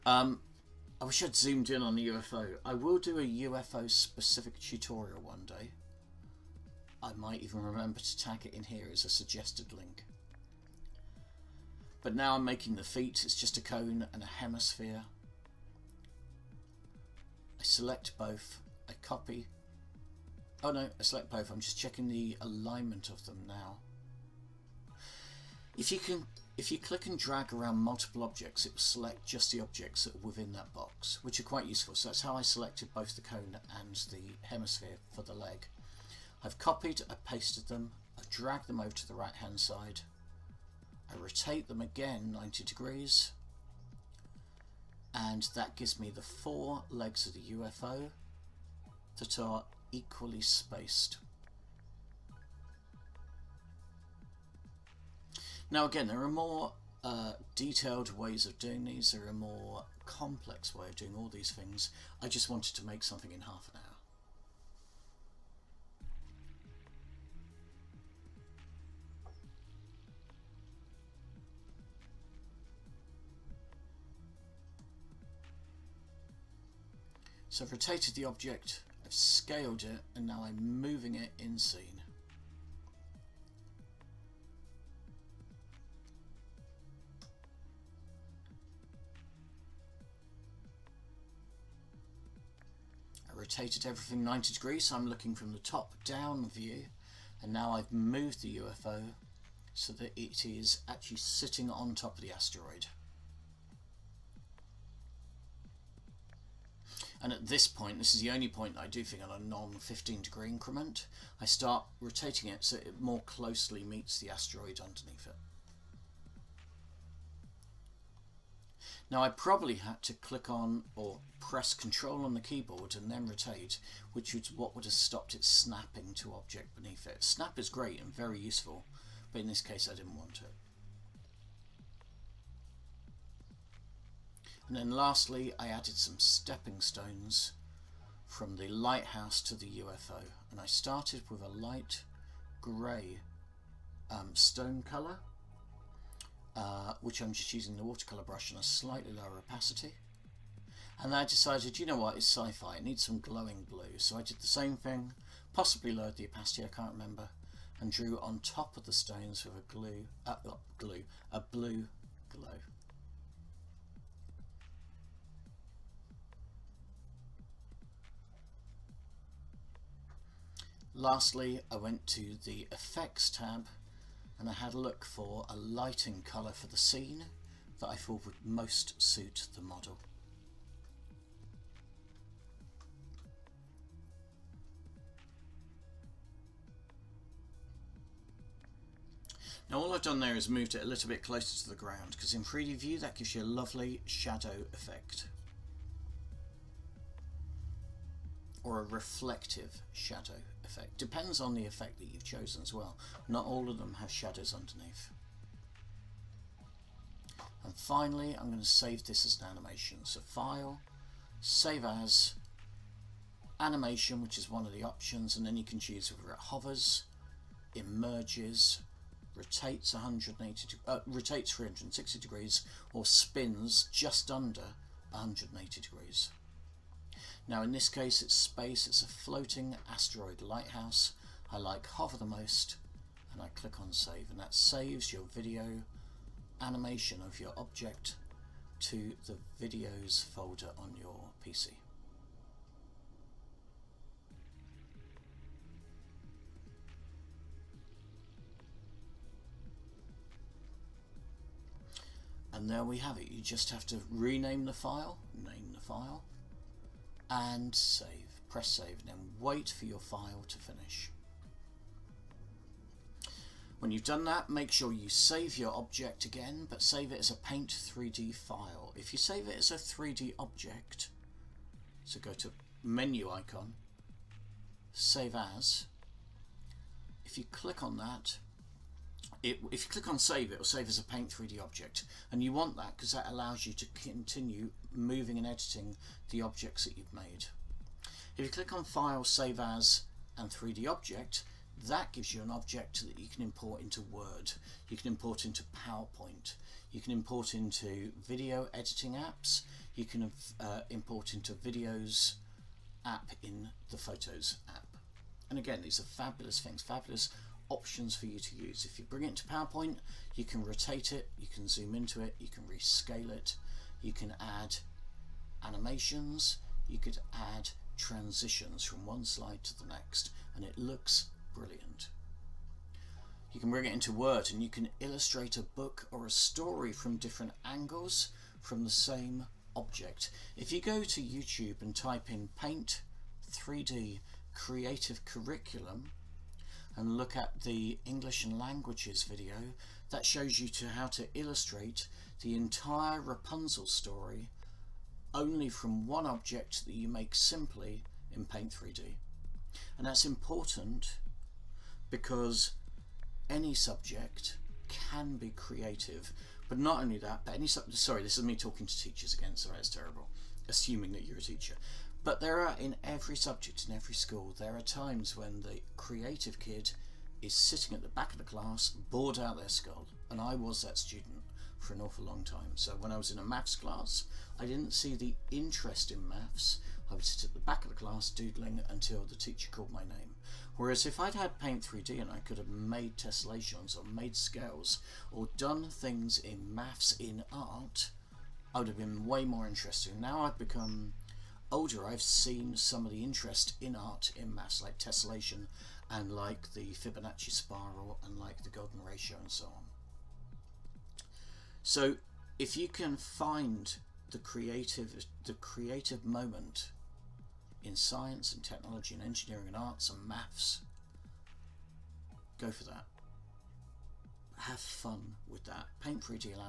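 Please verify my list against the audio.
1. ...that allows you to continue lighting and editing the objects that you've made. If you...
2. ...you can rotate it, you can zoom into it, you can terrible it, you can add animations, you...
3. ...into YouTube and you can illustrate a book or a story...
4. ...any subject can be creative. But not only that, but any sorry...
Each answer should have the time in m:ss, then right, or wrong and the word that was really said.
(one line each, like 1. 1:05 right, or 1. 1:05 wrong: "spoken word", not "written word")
1. 4:43 wrong: "moving", not "lighting"
2. 5:10 wrong: "rescale", not "terrible"
3. 5:23 wrong: "Word", not "YouTube"
4. 5:53 right.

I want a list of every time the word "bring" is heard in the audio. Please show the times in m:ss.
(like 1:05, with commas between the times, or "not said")
5:09, 5:23.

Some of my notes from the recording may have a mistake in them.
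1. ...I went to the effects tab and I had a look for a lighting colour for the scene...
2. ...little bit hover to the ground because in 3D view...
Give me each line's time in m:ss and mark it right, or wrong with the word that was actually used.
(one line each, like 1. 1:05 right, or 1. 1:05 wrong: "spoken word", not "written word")
1. 2:51 right
2. 3:10 wrong: "closer", not "hover".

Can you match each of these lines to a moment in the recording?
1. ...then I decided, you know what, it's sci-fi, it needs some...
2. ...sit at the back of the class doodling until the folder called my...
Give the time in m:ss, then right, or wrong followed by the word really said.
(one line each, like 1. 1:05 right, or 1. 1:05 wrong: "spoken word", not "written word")
1. 2:31 right
2. 6:17 wrong: "teacher", not "folder".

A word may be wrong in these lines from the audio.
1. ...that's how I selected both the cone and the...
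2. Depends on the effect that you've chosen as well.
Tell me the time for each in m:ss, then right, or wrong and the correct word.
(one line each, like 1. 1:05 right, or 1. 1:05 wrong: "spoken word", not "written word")
1. 0:32 right
2. 3:20 right.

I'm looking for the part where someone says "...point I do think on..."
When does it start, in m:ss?
1:48.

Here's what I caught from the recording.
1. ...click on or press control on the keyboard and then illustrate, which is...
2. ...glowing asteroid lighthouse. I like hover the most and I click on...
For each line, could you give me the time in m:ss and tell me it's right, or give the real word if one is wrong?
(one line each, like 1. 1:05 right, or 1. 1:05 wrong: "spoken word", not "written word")
1. 2:00 wrong: "rotate", not "illustrate"
2. 3:49 wrong: "floating", not "glowing".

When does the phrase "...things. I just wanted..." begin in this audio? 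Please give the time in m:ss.
1:01.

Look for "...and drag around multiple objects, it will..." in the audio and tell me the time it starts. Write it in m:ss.
0:27.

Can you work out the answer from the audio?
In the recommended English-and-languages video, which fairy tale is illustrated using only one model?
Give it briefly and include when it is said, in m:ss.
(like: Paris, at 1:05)
Rapunzel, at 5:43.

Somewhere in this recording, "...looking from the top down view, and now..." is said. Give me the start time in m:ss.
1:35.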